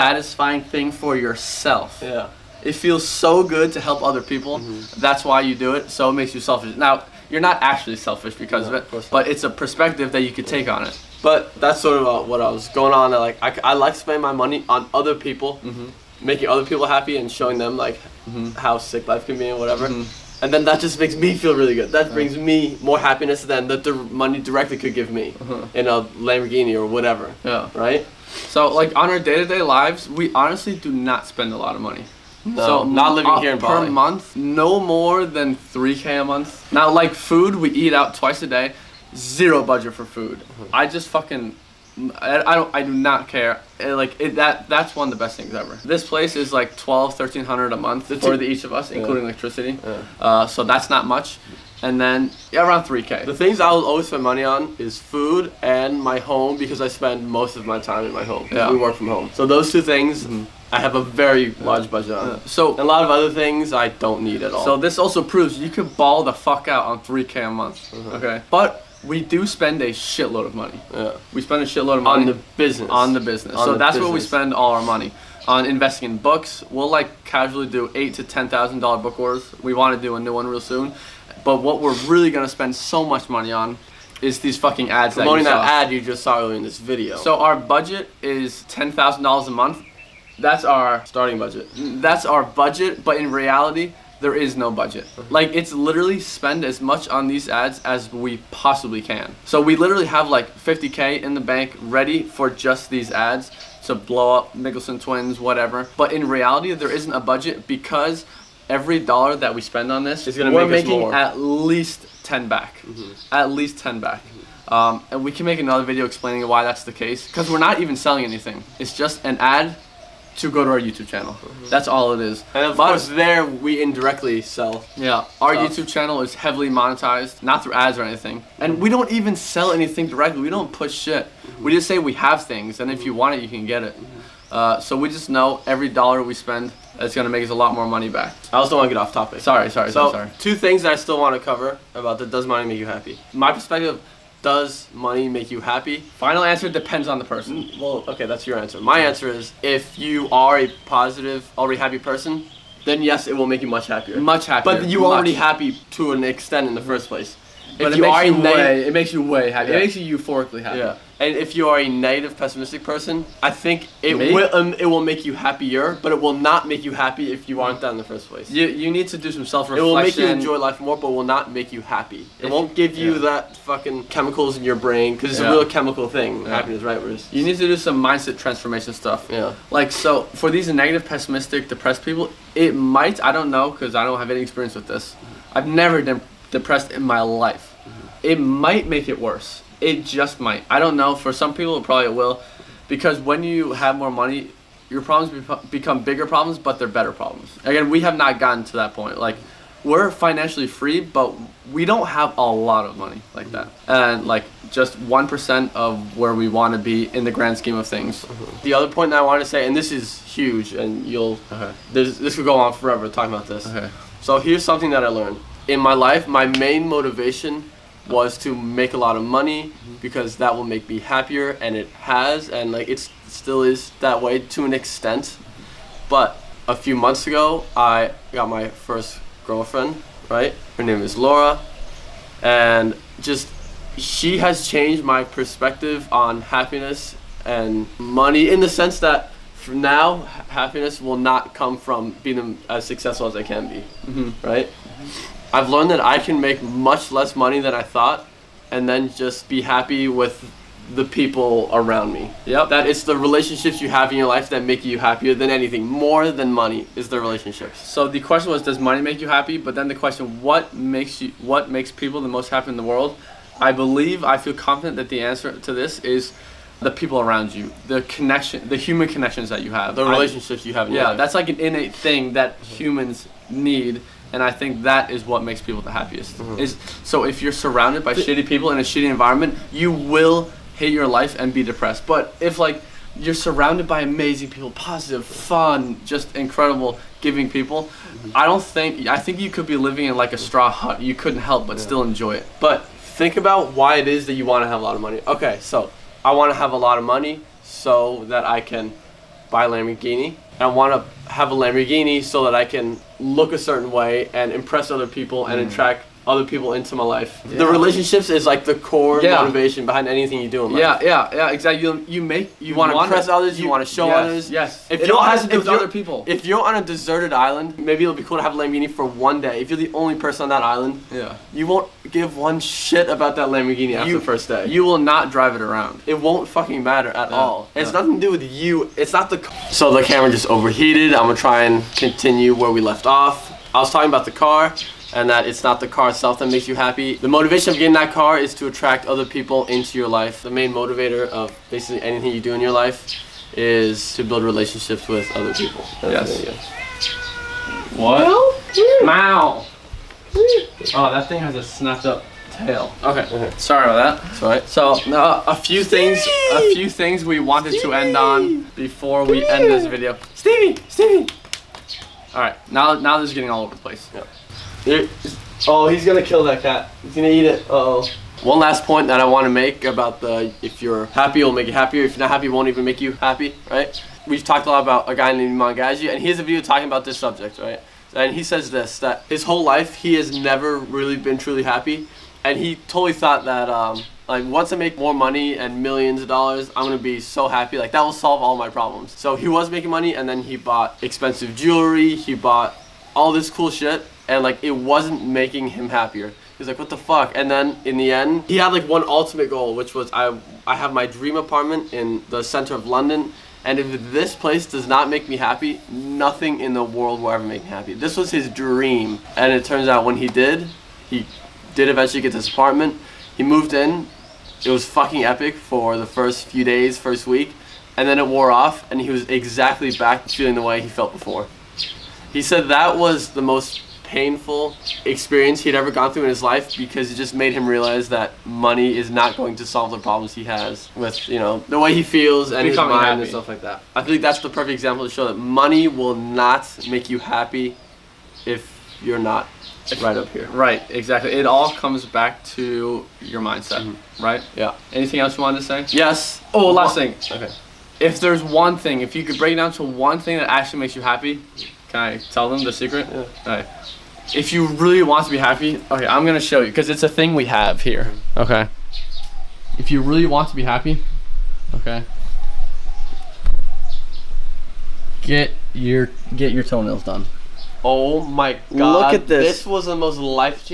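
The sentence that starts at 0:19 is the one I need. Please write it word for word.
Mm-hmm and then that just makes me feel really good.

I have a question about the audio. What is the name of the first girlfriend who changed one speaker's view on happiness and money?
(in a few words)
Laura.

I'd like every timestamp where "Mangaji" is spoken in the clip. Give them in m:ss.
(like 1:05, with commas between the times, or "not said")
6:15.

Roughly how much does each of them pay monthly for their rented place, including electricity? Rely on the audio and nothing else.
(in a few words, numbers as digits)
12 1300 a month.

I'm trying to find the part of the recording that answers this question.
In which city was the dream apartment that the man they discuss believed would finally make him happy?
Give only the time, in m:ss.
6:42.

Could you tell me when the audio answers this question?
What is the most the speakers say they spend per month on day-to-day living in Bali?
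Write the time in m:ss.
0:34.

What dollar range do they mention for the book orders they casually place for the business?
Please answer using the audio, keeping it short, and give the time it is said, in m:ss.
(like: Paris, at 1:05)
8,000 to 10,000 dollars, at 1:17.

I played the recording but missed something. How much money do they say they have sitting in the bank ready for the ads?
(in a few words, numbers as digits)
50k.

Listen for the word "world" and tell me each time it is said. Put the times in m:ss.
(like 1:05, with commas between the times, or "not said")
4:22, 6:46.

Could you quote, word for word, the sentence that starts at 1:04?
So this also proves you could ball the fuck out on 3k a month.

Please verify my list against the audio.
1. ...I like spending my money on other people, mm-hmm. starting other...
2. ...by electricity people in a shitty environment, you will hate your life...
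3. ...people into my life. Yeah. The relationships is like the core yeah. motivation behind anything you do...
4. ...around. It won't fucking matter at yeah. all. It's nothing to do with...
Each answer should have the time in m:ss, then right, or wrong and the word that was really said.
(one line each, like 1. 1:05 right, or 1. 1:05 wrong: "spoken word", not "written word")
1. 0:13 wrong: "making", not "starting"
2. 4:38 wrong: "shitty", not "electricity"
3. 5:06 right
4. 5:25 right.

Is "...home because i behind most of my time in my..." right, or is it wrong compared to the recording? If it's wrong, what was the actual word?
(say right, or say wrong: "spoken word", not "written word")
wrong: "spend", not "behind".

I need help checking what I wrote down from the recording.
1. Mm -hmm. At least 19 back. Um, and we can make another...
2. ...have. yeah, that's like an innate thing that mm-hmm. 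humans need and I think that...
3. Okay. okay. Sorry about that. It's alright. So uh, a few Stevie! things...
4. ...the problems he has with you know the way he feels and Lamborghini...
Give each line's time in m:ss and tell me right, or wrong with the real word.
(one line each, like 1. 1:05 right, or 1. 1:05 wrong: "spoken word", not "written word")
1. 1:52 wrong: "10", not "19"
2. 4:30 right
3. 5:53 right
4. 7:09 wrong: "Becoming", not "Lamborghini".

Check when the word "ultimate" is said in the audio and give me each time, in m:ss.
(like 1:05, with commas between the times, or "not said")
6:39.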